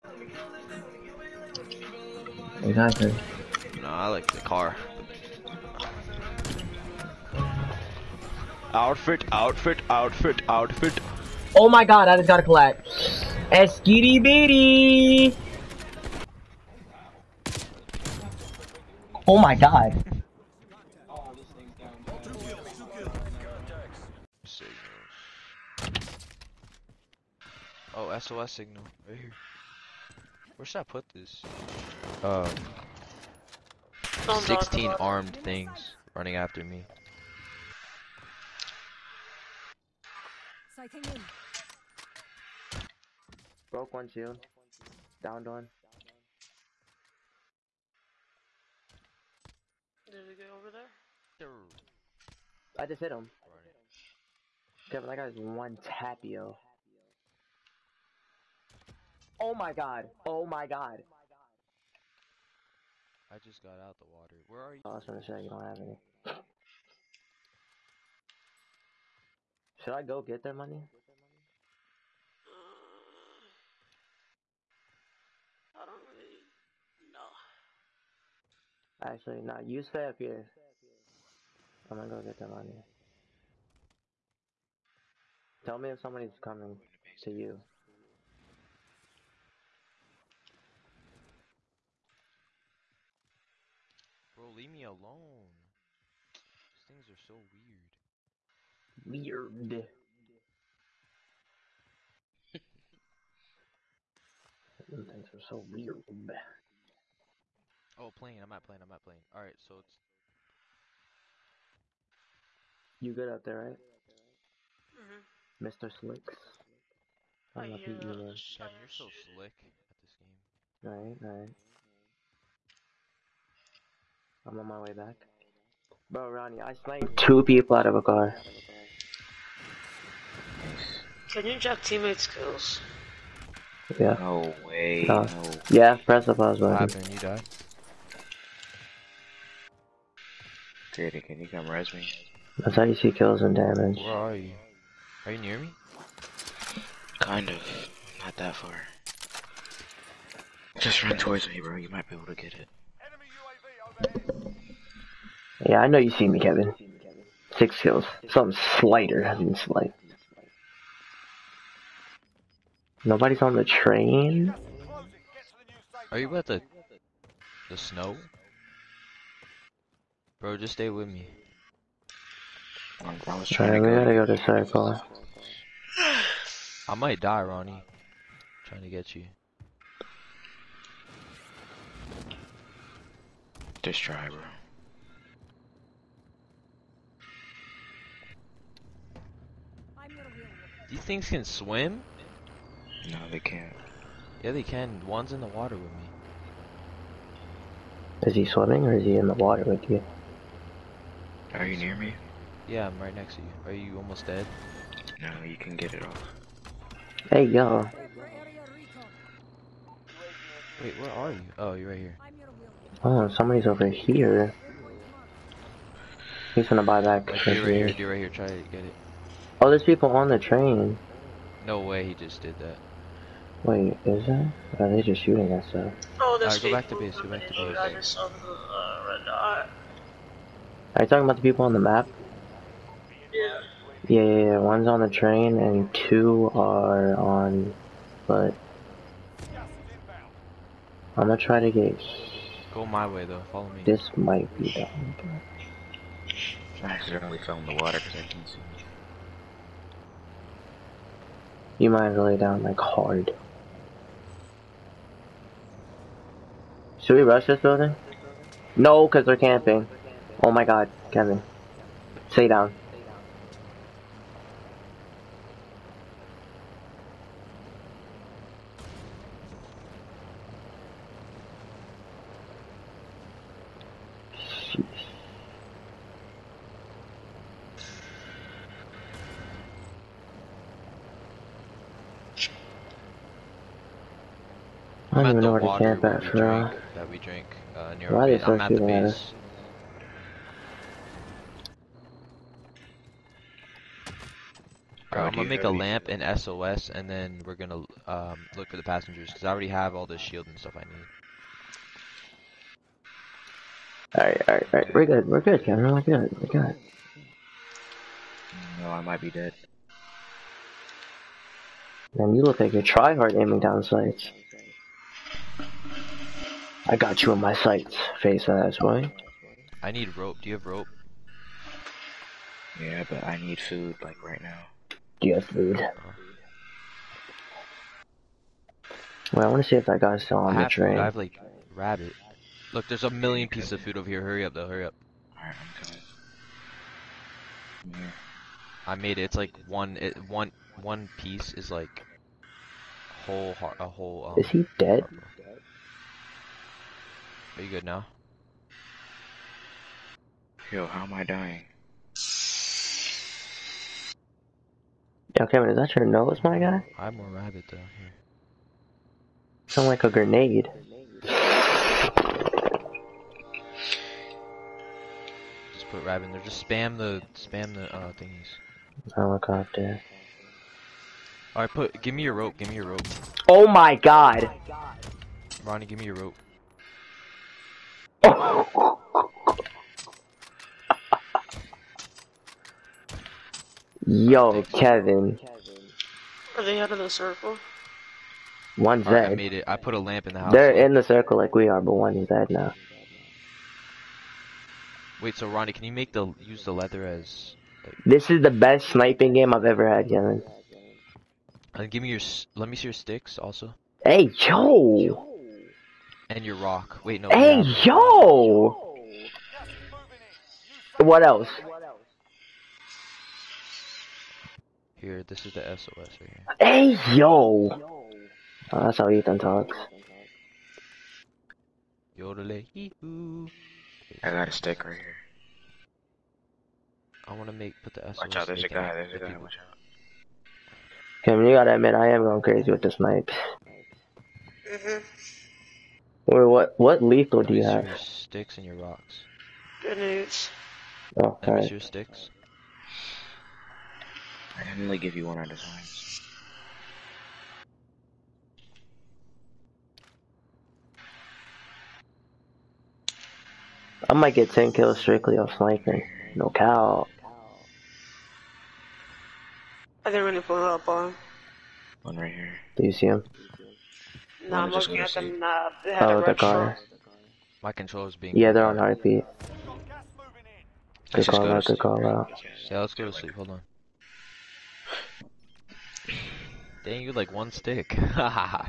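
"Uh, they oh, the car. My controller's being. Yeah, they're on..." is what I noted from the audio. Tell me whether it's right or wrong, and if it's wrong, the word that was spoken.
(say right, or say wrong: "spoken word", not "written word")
right.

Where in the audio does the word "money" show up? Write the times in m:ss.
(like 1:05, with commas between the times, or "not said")
1:10, 1:22.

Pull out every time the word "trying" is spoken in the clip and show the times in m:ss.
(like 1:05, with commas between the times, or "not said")
2:53, 2:58.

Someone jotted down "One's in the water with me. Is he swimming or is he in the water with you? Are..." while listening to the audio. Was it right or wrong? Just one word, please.
right.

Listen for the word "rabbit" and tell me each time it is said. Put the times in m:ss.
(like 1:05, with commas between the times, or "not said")
5:31, 5:57, 6:06.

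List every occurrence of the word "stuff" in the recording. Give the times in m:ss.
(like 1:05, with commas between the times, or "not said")
5:00.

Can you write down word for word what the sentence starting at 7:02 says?
Yodelay, I got a stick right here.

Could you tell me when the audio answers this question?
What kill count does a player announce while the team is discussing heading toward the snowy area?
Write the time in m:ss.
2:37.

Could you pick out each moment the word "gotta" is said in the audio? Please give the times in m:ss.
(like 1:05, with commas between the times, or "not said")
2:53, 7:11.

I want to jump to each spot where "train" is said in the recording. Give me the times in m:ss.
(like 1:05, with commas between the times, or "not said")
2:43, 3:40, 3:55, 5:30.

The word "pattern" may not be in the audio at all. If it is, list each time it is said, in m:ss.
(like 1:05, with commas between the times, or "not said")
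not said.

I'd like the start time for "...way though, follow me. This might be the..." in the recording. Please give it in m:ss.
4:03.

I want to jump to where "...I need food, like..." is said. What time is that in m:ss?
5:23.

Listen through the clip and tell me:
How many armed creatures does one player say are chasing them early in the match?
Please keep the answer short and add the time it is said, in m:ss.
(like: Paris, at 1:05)
16, at 0:34.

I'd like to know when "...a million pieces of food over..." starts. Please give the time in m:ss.
5:33.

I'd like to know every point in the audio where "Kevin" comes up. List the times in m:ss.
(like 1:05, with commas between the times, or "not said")
0:54, 2:36, 4:21, 5:05, 5:55, 6:24, 6:40.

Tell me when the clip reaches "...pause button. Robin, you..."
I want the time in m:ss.
2:16.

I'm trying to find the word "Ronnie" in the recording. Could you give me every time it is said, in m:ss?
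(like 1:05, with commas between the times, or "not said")
2:06, 2:57, 6:15, 6:35.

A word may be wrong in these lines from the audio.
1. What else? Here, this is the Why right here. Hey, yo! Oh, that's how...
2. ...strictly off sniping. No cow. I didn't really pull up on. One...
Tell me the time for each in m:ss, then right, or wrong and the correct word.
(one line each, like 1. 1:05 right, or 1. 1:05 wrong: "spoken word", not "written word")
1. 6:50 wrong: "SOS", not "Why"
2. 7:34 right.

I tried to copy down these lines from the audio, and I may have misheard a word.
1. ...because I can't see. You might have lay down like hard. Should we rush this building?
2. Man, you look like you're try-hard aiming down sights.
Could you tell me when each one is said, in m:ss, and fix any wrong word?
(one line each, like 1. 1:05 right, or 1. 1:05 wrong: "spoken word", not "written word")
1. 4:08 right
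2. 5:12 right.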